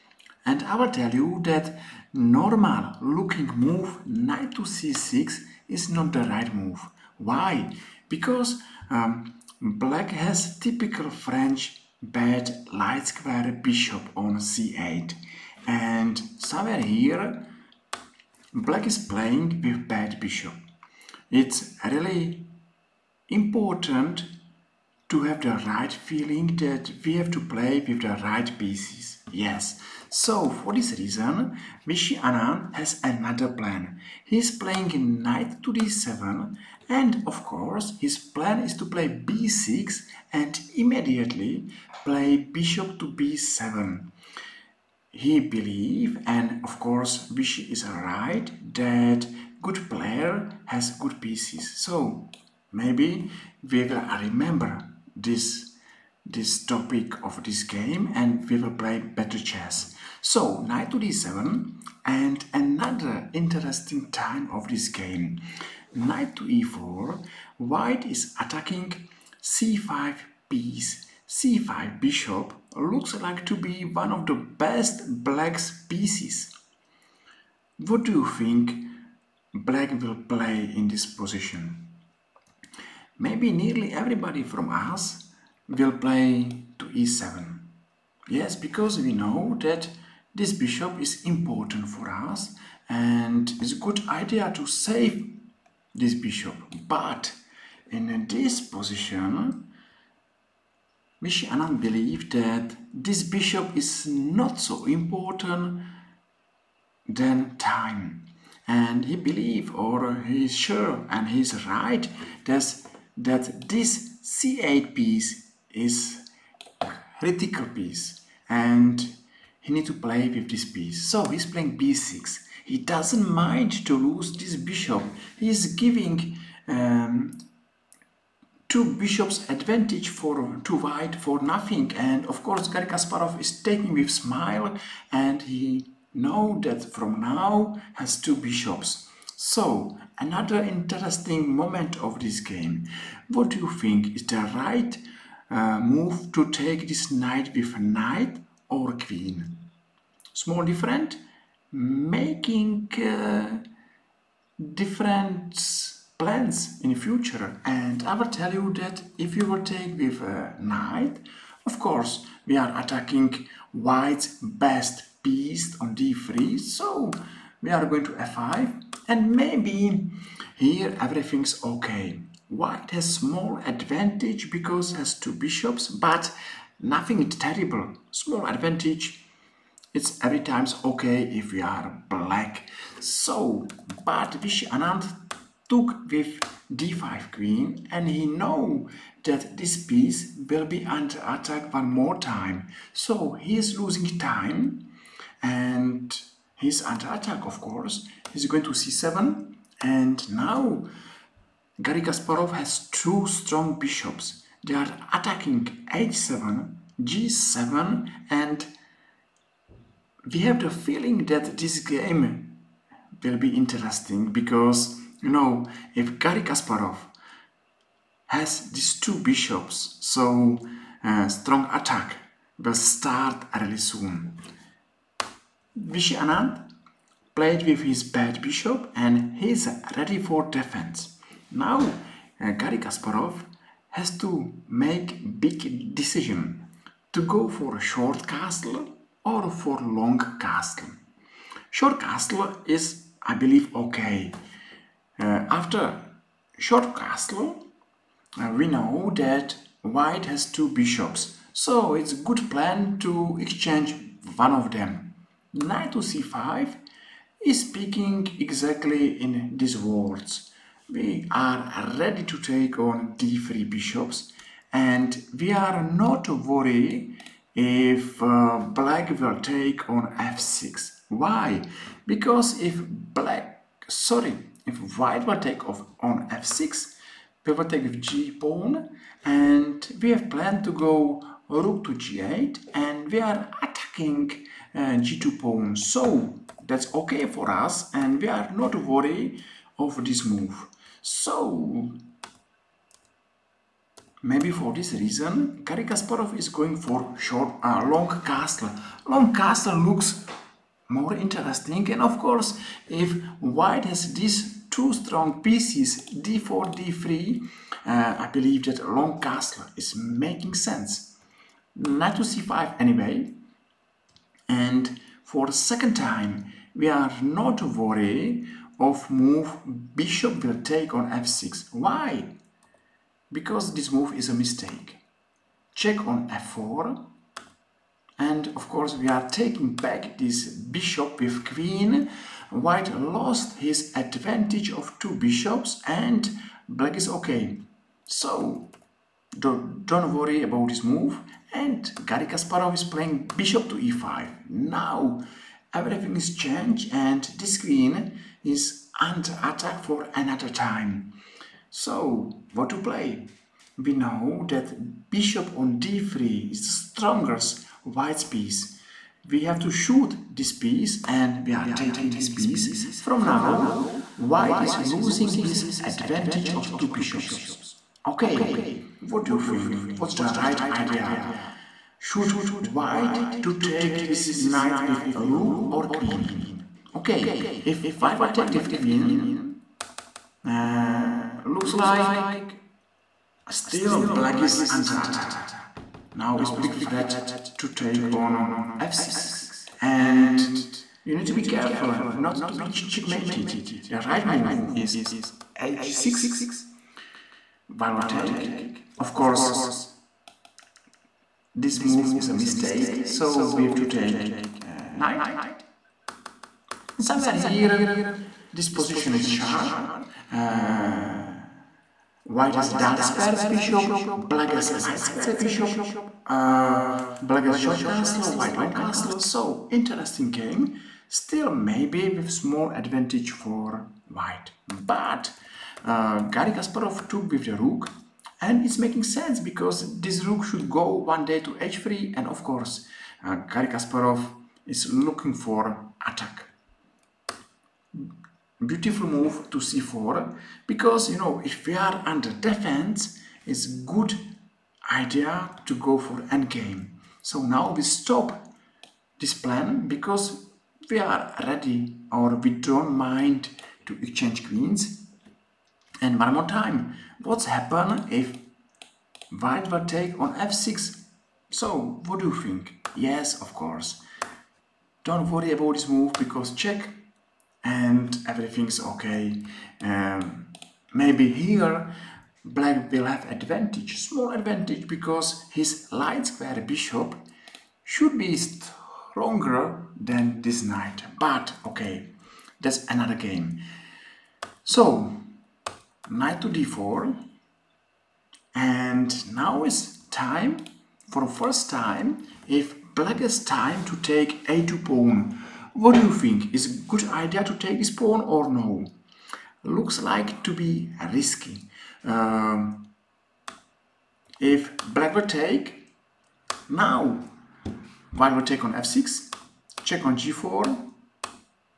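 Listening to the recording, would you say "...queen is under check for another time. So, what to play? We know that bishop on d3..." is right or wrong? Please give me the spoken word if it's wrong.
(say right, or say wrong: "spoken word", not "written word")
wrong: "attack", not "check".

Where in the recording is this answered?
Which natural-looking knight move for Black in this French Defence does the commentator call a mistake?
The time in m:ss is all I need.
0:04.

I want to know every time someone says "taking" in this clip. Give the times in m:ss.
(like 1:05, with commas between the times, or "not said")
2:13, 5:29, 6:01.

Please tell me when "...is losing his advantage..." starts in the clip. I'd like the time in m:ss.
6:04.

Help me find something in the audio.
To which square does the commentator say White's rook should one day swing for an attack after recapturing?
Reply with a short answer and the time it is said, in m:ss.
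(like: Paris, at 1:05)
h3, at 7:11.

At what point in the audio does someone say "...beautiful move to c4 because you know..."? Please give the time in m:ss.
7:18.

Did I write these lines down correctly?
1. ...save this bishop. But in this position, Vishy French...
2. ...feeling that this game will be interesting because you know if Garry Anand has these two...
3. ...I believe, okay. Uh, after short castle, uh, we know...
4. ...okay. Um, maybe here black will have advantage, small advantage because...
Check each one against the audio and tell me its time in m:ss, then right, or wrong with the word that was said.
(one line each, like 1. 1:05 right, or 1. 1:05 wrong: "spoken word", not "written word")
1. 1:34 wrong: "Anand", not "French"
2. 3:30 wrong: "Kasparov", not "Anand"
3. 4:03 right
4. 7:48 right.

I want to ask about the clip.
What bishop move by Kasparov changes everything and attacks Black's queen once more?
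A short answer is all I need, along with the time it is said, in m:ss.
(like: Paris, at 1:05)
Bishop to e5, at 5:43.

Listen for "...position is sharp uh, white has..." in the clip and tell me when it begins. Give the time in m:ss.
6:48.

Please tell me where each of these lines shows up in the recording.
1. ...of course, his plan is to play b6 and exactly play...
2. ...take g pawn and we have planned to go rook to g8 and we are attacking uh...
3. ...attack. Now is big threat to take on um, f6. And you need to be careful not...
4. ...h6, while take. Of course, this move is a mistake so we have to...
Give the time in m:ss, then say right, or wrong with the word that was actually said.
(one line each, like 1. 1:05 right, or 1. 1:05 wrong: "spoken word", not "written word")
1. 0:37 wrong: "immediately", not "exactly"
2. 4:37 right
3. 6:24 right
4. 6:35 right.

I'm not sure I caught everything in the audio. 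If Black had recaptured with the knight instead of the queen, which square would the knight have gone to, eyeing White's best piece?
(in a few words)
f5.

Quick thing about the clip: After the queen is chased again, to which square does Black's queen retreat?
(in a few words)
c7.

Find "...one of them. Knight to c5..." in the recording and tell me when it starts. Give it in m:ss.
4:14.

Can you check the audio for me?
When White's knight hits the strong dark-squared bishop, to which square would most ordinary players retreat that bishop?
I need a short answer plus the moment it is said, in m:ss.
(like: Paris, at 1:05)
e7, at 1:26.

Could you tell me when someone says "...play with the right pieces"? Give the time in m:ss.
0:27.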